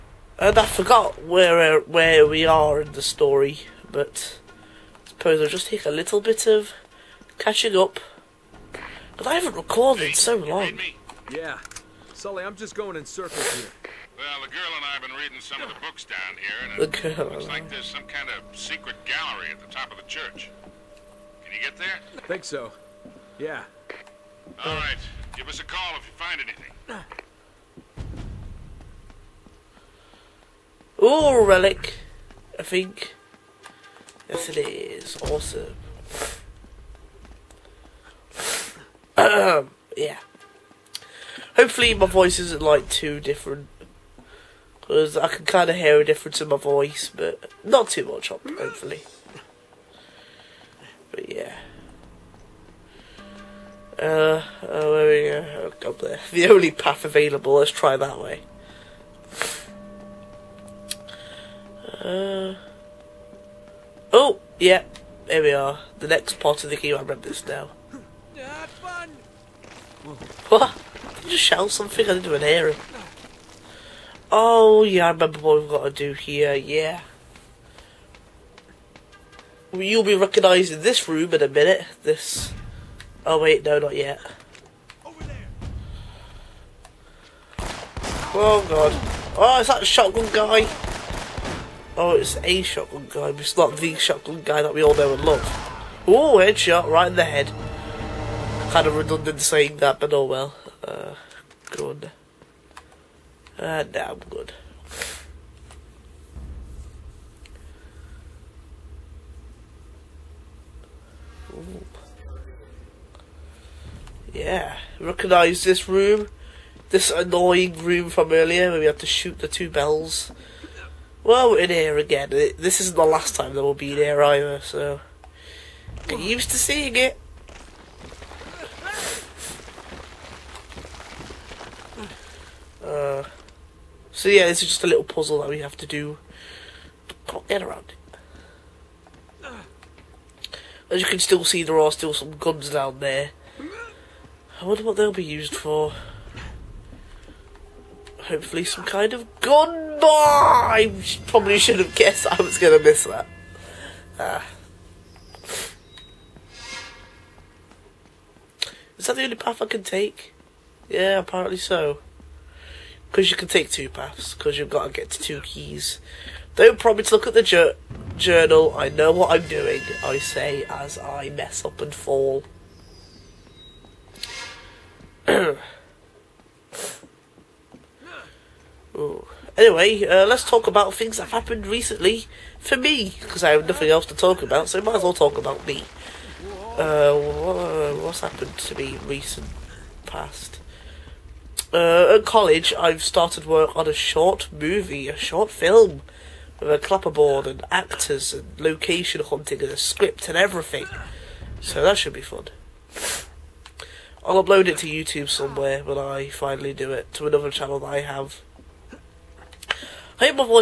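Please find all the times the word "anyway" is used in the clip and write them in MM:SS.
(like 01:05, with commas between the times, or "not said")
02:55.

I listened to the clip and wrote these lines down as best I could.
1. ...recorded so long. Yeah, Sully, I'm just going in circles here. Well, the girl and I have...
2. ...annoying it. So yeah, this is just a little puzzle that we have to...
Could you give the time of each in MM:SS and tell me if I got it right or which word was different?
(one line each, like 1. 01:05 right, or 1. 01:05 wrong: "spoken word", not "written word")
1. 00:09 right
2. 02:06 wrong: "seeing", not "annoying".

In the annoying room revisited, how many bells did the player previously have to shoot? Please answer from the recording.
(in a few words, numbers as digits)
2.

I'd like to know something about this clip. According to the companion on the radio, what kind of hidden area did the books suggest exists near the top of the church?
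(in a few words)
secret gallery.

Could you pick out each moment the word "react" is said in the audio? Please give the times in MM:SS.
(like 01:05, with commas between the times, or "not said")
not said.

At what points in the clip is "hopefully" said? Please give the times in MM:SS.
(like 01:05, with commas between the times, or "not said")
00:41, 00:48, 02:28.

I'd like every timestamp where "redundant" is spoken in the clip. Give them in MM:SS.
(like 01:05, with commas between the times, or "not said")
01:38.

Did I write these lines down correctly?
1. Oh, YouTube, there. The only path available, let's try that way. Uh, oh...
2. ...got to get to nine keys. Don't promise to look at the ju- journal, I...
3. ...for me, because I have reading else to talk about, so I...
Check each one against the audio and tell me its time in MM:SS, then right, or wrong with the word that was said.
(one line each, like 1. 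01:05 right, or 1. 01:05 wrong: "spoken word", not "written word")
1. 00:55 wrong: "God", not "YouTube"
2. 02:44 wrong: "two", not "nine"
3. 03:02 wrong: "nothing", not "reading".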